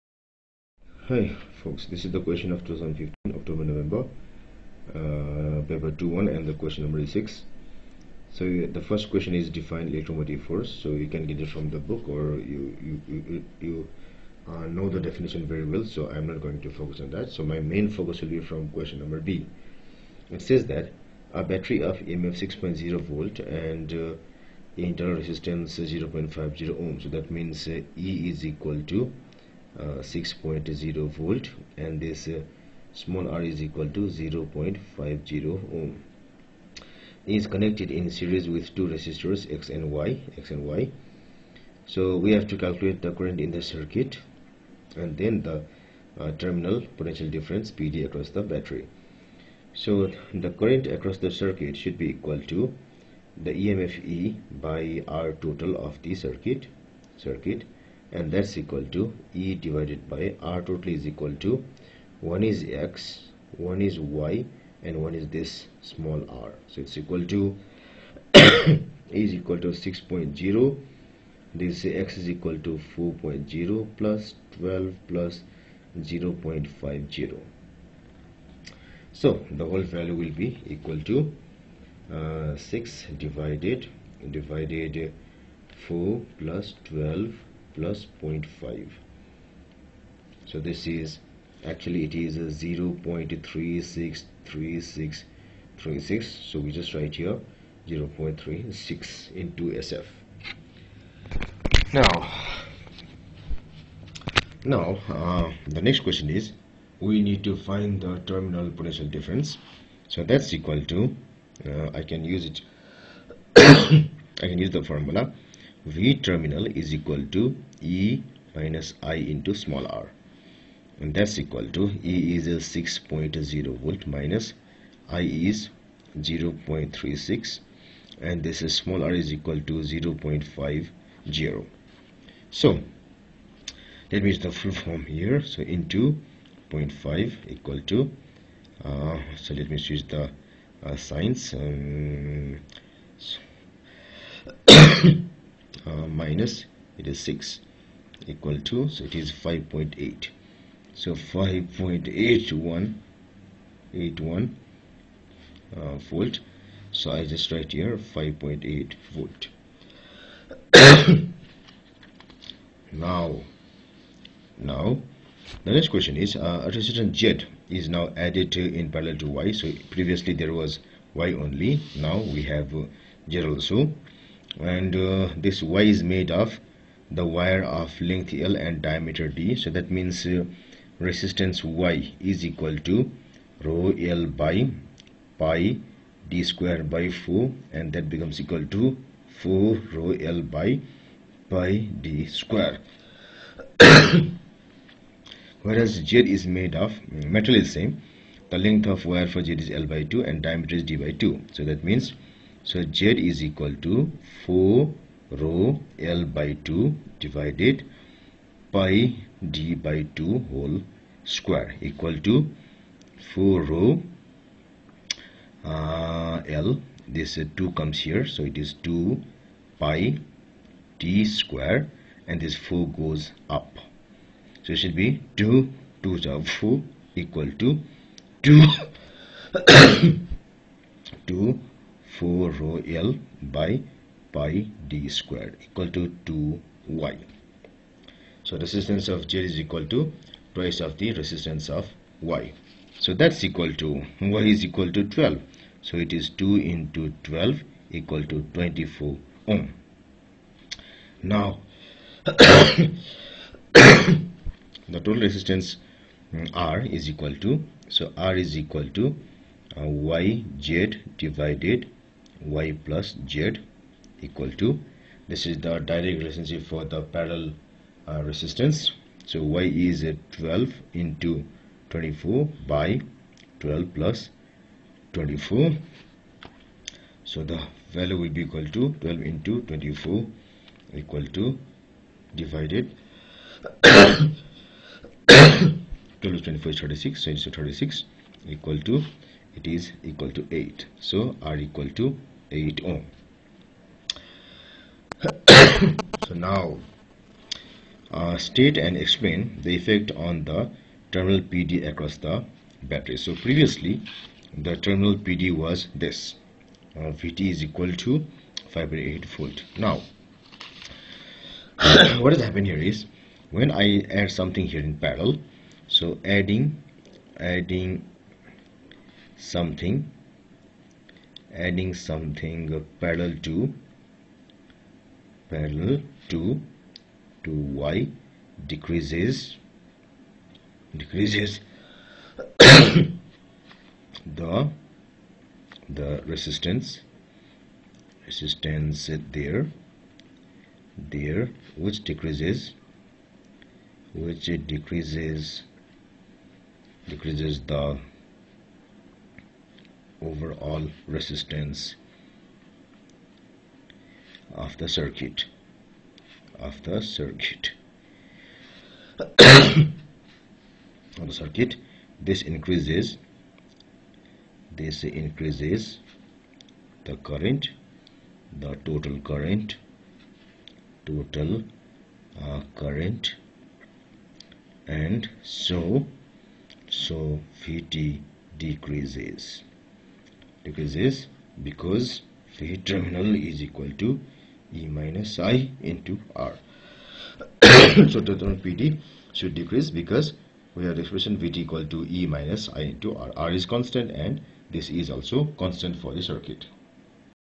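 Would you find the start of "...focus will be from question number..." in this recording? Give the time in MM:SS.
00:17.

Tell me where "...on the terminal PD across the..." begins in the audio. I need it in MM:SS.
05:00.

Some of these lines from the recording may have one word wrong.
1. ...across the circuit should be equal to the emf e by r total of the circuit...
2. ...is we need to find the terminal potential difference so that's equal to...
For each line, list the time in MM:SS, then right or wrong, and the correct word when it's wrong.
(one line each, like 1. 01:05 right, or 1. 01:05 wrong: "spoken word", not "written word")
1. 00:50 right
2. 01:46 right.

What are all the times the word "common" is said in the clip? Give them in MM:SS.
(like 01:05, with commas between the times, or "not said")
not said.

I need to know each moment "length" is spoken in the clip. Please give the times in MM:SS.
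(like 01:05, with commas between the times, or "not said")
02:58, 03:18.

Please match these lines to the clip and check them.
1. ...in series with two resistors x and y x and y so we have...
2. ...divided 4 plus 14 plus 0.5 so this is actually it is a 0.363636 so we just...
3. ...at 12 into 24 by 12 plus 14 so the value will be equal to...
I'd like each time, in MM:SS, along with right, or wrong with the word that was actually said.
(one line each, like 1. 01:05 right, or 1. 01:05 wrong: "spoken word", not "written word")
1. 00:37 right
2. 01:24 wrong: "12", not "14"
3. 04:30 wrong: "24", not "14".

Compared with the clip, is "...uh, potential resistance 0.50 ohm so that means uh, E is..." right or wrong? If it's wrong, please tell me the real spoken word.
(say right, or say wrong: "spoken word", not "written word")
wrong: "internal", not "potential".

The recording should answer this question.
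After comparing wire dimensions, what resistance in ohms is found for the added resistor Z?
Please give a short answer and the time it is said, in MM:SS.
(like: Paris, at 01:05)
24 ohm, at 04:08.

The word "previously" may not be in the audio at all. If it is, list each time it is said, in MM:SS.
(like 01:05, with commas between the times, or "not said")
02:49, 05:03.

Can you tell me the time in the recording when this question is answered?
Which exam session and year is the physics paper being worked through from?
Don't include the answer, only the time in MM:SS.
00:02.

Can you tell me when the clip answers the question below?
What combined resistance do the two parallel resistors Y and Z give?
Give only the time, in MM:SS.
04:51.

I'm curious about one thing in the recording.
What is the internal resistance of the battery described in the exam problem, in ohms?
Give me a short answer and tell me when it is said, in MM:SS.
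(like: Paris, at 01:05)
0.50 ohm, at 00:32.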